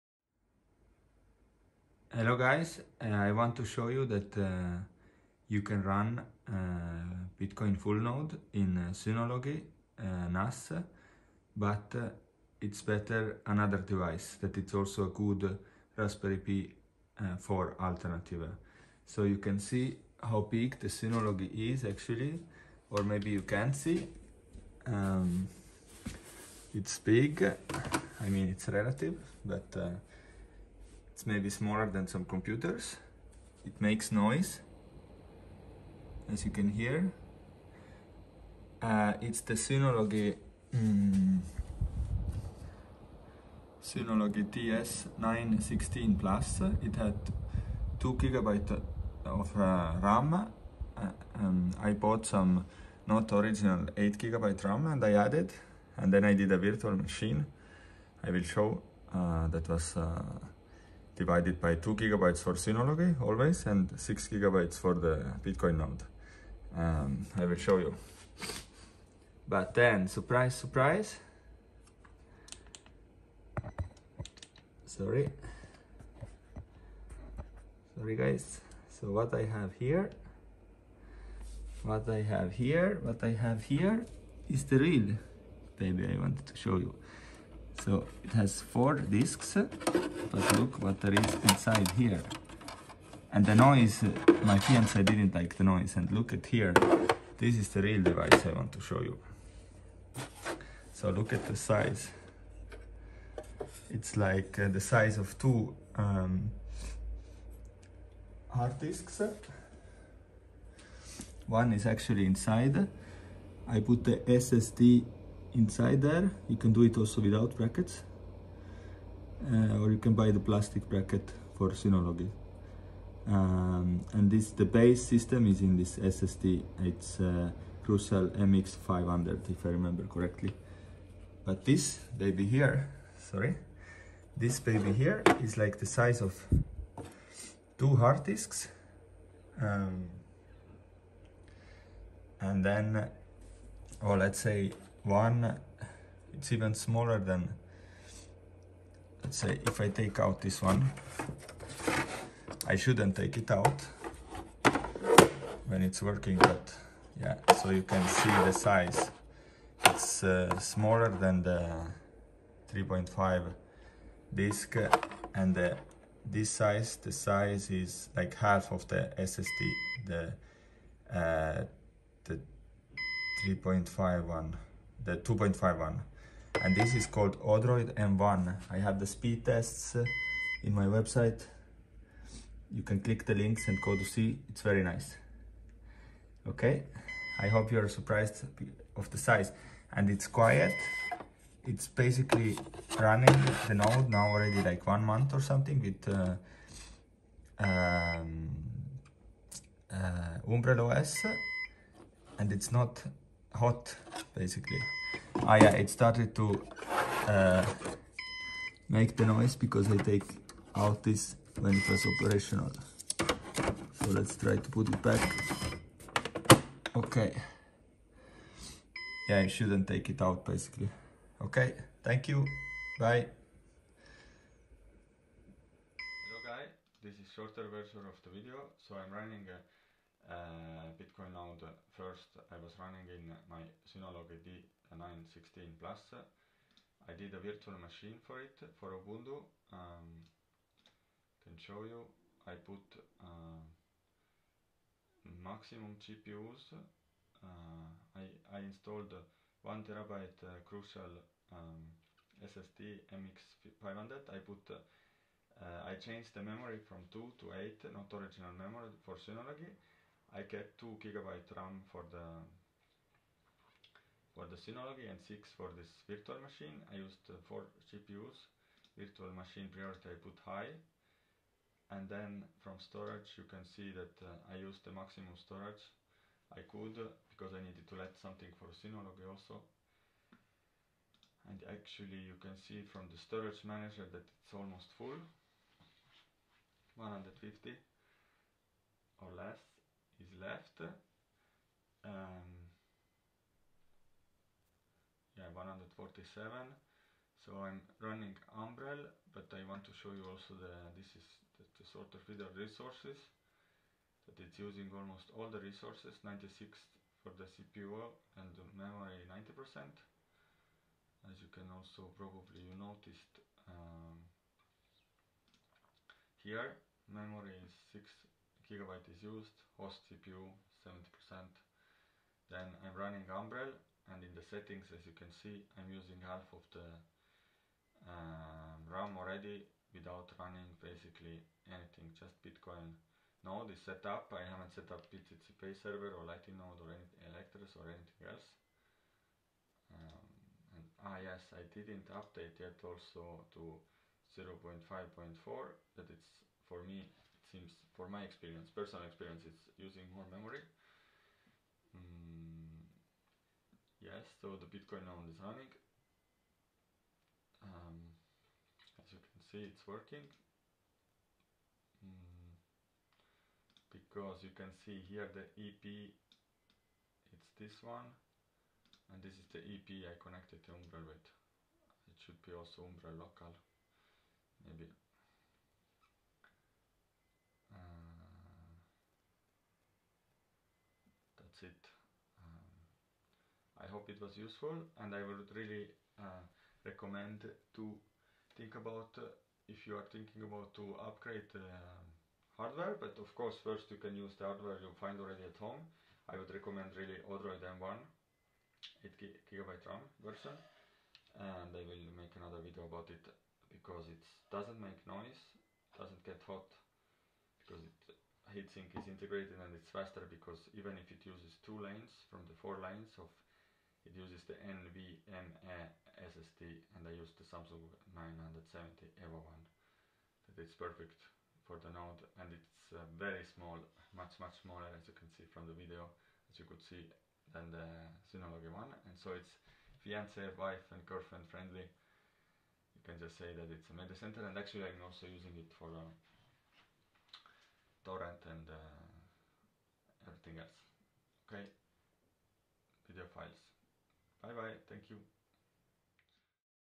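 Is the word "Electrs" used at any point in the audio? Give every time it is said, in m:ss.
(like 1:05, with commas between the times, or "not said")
5:37.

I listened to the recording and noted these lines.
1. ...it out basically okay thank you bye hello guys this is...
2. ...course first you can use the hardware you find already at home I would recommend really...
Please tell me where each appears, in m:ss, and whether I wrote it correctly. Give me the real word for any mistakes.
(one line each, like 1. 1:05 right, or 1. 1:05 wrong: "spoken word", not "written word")
1. 3:40 right
2. 6:33 right.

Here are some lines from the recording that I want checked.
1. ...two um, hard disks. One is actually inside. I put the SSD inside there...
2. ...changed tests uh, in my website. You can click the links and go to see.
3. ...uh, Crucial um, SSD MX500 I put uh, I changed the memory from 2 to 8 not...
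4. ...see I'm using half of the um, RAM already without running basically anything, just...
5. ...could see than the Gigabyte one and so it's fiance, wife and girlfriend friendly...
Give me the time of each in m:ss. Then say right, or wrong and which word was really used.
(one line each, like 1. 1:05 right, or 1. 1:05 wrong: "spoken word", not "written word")
1. 1:45 right
2. 2:59 wrong: "speed", not "changed"
3. 4:10 right
4. 5:25 right
5. 7:06 wrong: "Synology", not "Gigabyte".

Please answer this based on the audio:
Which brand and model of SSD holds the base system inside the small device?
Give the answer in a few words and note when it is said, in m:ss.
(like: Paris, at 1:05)
Crucial MX500, at 2:07.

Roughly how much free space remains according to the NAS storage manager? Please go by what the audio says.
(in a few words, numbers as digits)
147.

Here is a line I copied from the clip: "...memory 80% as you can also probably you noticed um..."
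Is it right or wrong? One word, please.
wrong.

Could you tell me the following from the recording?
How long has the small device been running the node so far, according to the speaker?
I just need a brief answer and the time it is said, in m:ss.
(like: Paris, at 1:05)
one month, at 3:14.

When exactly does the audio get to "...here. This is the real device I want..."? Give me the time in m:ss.
1:36.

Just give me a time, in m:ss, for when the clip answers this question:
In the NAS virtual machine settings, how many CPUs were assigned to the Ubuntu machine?
4:27.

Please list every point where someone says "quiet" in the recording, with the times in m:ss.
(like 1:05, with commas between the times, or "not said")
3:10.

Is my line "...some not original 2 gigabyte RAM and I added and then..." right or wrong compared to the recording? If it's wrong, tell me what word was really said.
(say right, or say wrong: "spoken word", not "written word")
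wrong: "8", not "2".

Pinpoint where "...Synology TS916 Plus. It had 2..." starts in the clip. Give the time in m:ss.
0:43.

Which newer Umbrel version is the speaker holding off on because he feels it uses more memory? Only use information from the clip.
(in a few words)
0.5.4.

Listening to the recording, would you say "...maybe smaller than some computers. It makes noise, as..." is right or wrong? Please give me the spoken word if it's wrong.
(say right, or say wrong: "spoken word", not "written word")
right.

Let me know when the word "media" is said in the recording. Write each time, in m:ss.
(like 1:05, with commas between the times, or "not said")
7:13.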